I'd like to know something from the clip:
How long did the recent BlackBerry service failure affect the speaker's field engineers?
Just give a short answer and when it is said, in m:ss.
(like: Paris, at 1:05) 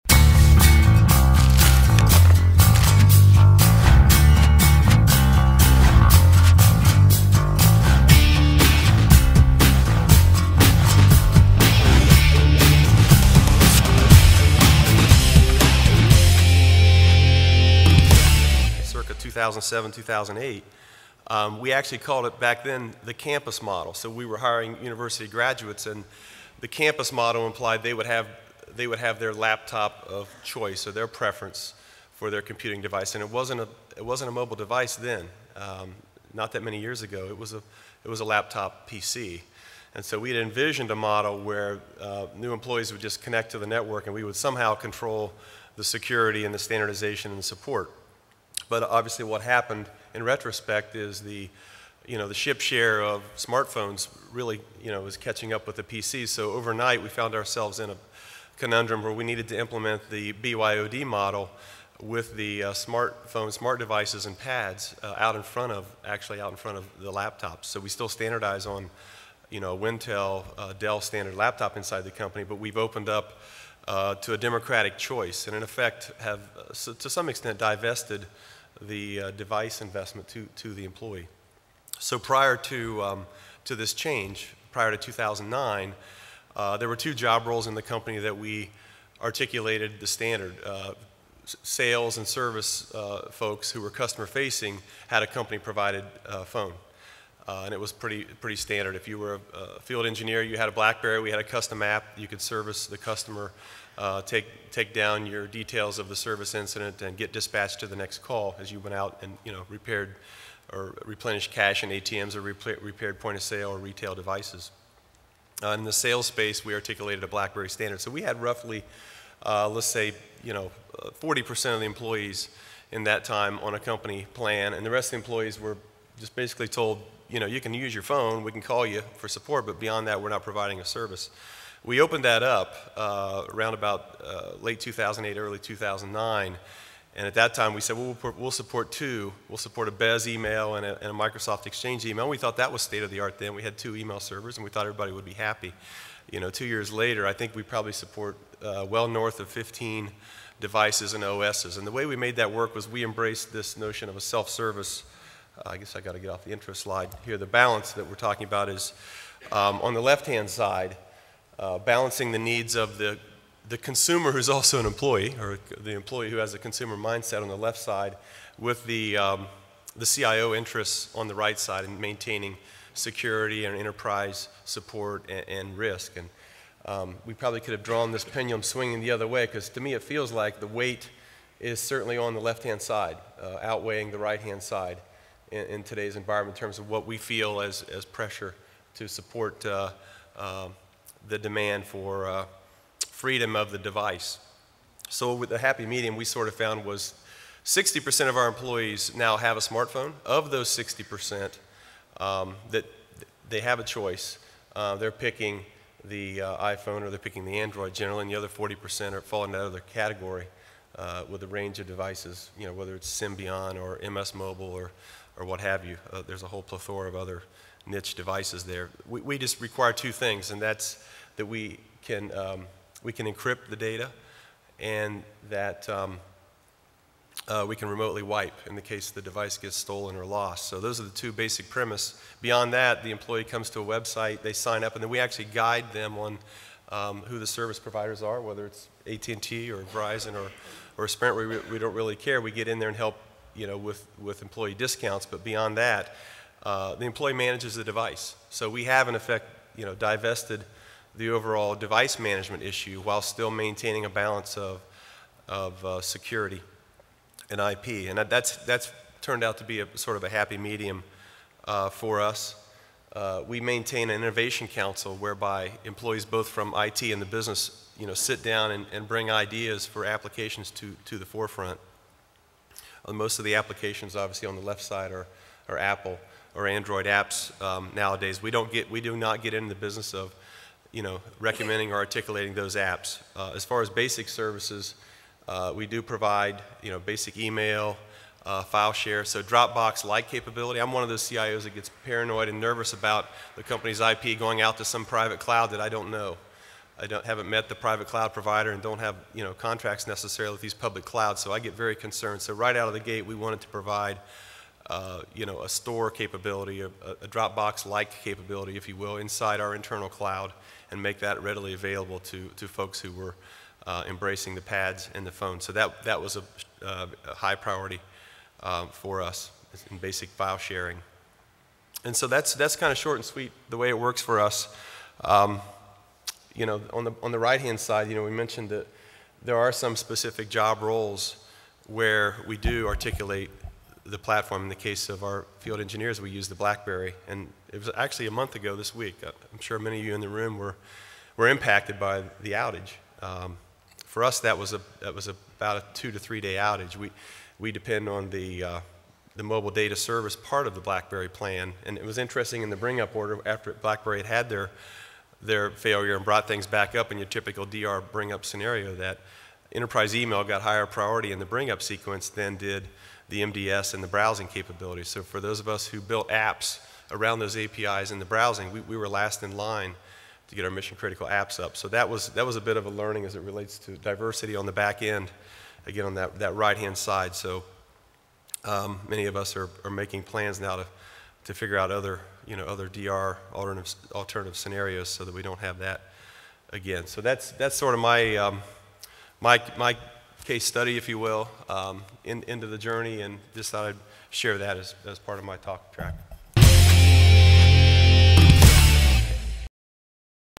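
2 to 3 days, at 5:45.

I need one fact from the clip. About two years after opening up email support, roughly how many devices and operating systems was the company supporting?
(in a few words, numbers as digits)
north of 15.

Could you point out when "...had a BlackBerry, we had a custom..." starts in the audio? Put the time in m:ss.
1:40.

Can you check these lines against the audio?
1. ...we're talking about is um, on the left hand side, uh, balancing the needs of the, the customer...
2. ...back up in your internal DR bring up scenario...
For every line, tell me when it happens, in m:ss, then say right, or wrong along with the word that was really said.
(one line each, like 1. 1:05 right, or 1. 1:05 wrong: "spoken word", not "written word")
1. 2:38 wrong: "consumer", not "customer"
2. 5:56 wrong: "typical", not "internal".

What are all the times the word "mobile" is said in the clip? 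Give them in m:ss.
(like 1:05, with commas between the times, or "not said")
0:34, 3:34, 5:49.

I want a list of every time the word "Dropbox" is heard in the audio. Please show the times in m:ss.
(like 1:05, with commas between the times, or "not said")
4:49, 5:07.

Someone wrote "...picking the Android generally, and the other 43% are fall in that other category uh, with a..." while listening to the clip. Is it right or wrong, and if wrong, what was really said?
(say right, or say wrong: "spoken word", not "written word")
wrong: "40", not "43".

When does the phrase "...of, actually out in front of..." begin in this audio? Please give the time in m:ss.
1:05.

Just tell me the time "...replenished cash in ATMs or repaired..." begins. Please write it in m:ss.
1:51.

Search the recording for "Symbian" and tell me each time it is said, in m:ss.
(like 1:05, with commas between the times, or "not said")
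3:33.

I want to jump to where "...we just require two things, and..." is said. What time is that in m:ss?
3:39.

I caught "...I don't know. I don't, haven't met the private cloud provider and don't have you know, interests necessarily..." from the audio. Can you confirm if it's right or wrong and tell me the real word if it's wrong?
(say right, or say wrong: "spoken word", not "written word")
wrong: "contracts", not "interests".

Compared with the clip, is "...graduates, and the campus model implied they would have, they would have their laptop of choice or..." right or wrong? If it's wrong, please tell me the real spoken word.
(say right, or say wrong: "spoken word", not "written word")
right.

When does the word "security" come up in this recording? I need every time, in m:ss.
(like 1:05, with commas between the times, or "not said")
0:45, 2:52, 4:16.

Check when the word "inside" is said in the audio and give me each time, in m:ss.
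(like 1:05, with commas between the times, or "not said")
1:11, 5:09.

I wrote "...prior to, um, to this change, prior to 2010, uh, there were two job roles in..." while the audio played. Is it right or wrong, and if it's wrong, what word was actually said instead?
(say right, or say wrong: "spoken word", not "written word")
wrong: "2009", not "2010".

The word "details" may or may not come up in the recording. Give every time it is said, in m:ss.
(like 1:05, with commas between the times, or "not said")
1:45.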